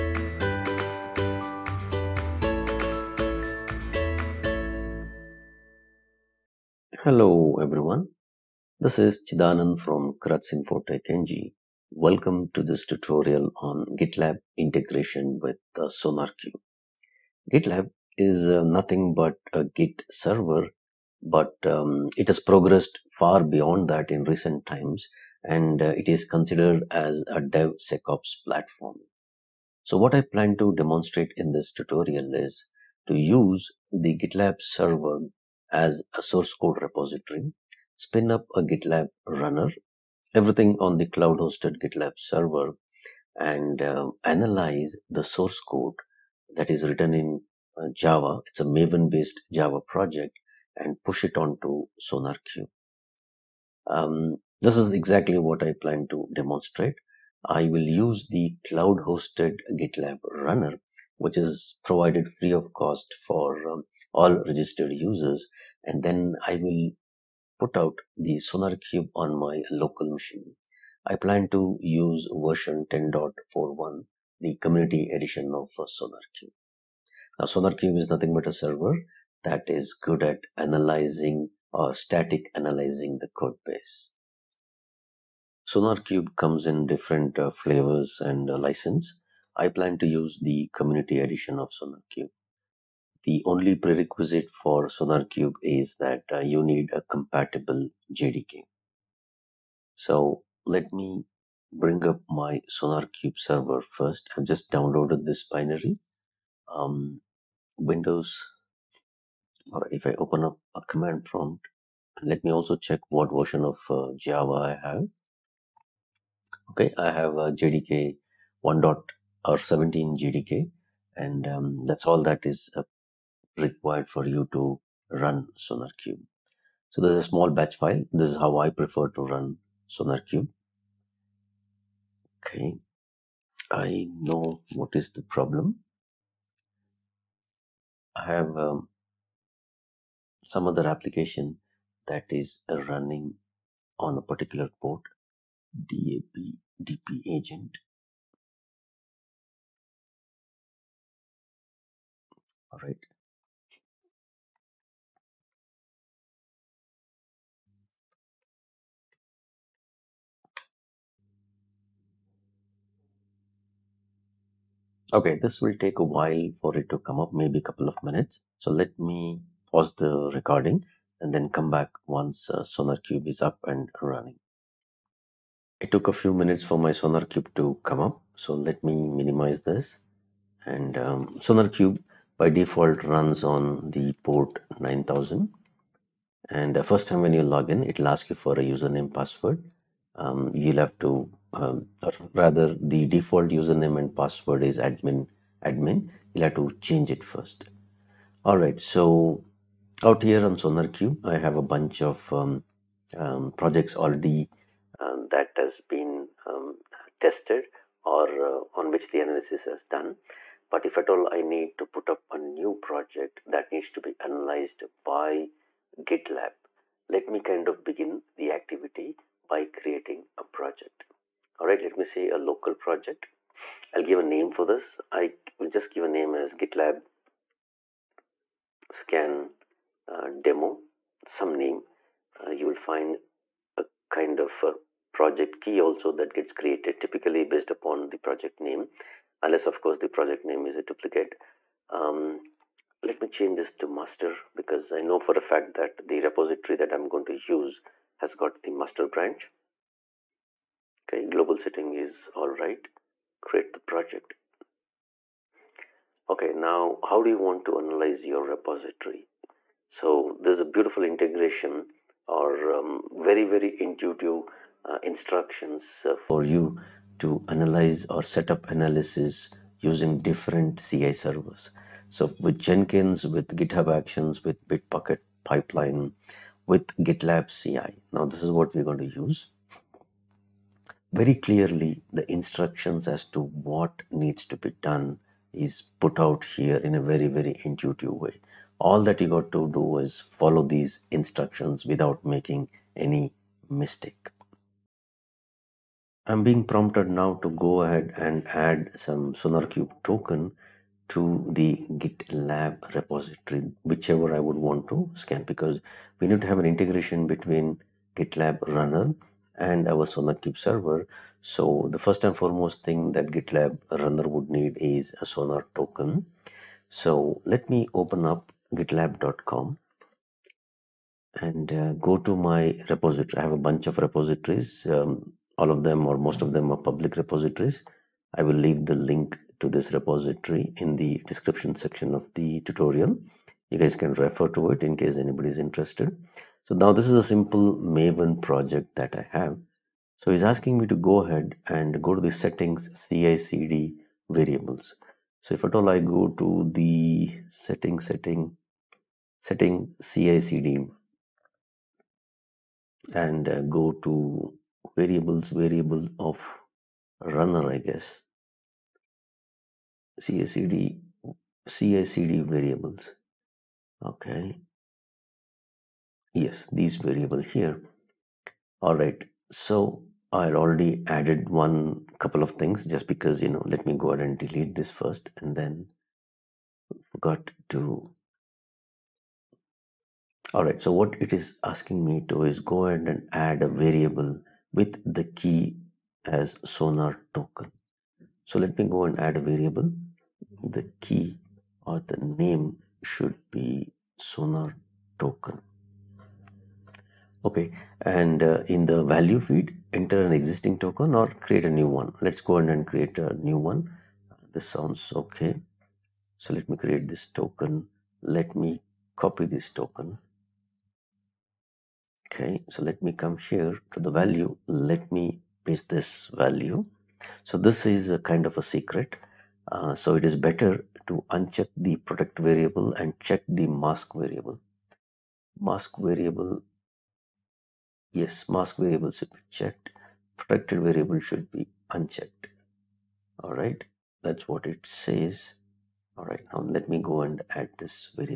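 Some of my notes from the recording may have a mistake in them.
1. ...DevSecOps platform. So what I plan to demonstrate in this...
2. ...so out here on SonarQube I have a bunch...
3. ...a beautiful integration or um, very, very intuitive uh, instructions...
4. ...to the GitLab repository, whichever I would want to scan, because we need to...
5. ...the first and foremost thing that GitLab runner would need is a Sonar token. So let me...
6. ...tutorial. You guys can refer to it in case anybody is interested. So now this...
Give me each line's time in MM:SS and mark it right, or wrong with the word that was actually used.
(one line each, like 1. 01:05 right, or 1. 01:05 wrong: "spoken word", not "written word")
1. 00:27 right
2. 03:18 right
3. 04:20 right
4. 05:01 right
5. 05:11 right
6. 05:32 right.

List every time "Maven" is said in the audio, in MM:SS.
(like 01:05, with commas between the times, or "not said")
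00:48, 05:37.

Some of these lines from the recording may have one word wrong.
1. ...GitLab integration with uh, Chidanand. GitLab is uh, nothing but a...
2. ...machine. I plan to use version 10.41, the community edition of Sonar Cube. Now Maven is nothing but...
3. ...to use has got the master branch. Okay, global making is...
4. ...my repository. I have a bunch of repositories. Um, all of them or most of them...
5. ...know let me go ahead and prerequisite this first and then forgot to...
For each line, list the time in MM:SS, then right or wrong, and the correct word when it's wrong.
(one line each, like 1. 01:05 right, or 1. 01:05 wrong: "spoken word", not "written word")
1. 00:14 wrong: "SonarQube", not "Chidanand"
2. 01:10 wrong: "SonarQube", not "Maven"
3. 04:07 wrong: "setting", not "making"
4. 05:22 right
5. 06:13 wrong: "delete", not "prerequisite".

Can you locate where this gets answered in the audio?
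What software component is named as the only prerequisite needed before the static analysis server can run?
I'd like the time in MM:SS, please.
01:37.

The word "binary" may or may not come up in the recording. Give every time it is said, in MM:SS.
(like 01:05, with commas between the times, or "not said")
01:45.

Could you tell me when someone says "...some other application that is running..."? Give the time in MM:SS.
02:20.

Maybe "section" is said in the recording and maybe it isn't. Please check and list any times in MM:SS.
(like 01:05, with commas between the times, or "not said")
05:31.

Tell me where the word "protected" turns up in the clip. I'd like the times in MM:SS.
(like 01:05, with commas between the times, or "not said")
07:01, 07:10.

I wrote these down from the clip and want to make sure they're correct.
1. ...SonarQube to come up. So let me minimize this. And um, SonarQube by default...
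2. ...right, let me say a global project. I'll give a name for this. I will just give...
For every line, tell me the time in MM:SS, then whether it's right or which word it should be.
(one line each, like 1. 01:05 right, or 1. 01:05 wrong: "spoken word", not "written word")
1. 02:56 right
2. 03:41 wrong: "local", not "global".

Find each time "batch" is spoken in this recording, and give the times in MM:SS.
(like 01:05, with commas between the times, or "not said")
02:07.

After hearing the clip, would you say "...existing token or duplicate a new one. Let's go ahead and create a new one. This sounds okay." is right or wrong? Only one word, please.
wrong.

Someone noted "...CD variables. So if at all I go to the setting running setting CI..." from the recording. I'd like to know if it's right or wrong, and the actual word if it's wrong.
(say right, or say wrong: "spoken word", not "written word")
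wrong: "setting", not "running".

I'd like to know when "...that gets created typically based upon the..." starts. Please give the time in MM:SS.
03:56.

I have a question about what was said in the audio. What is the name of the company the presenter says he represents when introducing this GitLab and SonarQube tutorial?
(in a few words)
CRUDS Infotech NG.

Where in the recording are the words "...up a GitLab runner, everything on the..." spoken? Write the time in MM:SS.
00:38.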